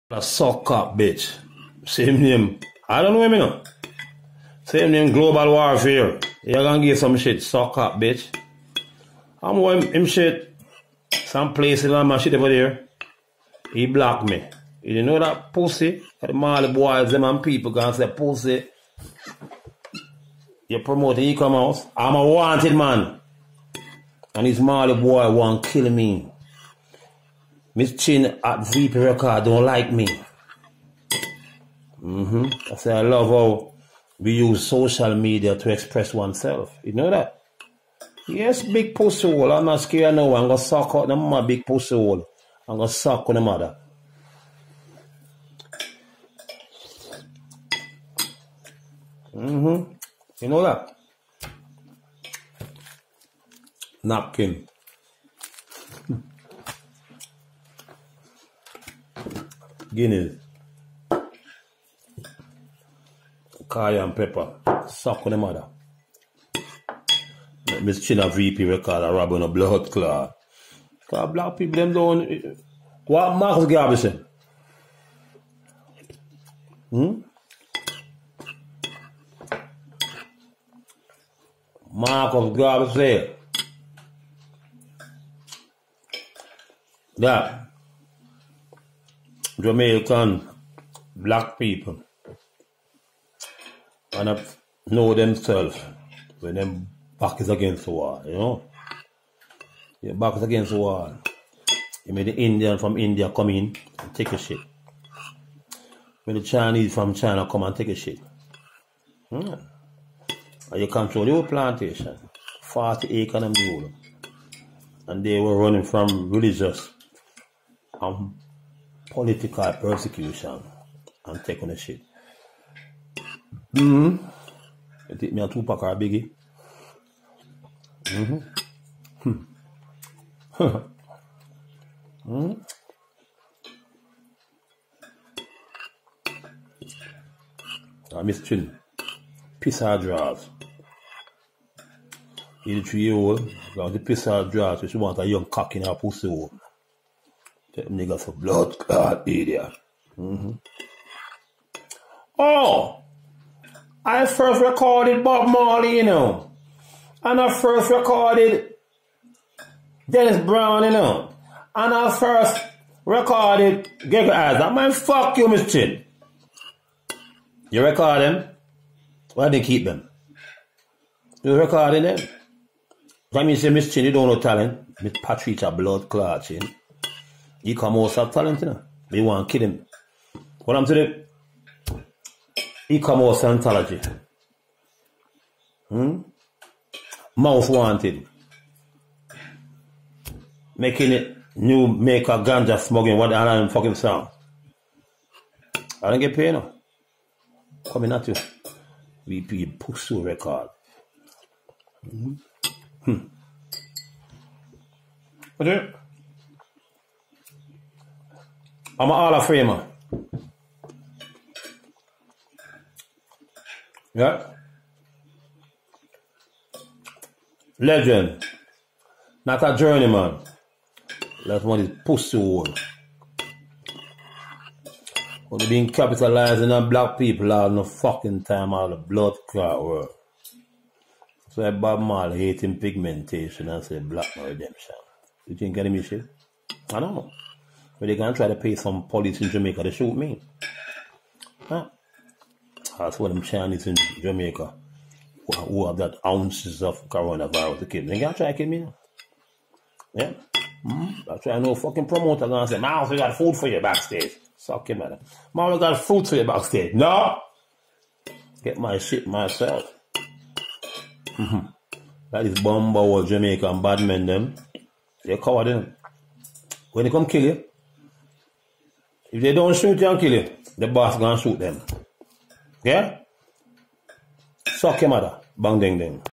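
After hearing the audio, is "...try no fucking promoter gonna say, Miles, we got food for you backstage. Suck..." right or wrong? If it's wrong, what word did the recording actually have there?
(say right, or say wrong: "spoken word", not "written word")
right.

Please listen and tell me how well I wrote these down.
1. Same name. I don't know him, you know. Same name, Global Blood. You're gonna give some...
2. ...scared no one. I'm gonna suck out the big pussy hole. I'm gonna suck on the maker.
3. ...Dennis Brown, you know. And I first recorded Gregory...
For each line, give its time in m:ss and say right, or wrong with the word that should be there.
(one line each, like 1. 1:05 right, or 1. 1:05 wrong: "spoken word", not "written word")
1. 0:01 wrong: "Warfare", not "Blood"
2. 0:39 wrong: "mother", not "maker"
3. 2:40 right.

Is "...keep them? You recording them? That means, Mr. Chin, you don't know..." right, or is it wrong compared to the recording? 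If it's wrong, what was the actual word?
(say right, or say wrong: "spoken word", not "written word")
right.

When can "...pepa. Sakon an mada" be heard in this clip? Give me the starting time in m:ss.
1:04.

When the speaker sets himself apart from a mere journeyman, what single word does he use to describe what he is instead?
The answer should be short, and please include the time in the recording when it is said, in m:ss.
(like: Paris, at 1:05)
Legend, at 3:37.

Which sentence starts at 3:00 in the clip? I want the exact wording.
What I'm saying, He come out Scientology.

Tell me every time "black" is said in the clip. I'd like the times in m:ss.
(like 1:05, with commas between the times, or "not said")
1:31, 3:46, 3:53.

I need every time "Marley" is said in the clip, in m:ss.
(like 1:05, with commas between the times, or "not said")
2:35, 3:52.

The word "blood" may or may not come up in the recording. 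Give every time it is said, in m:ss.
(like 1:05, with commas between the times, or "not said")
2:28, 2:55, 3:48.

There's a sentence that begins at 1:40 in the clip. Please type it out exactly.
Your back is against the wall.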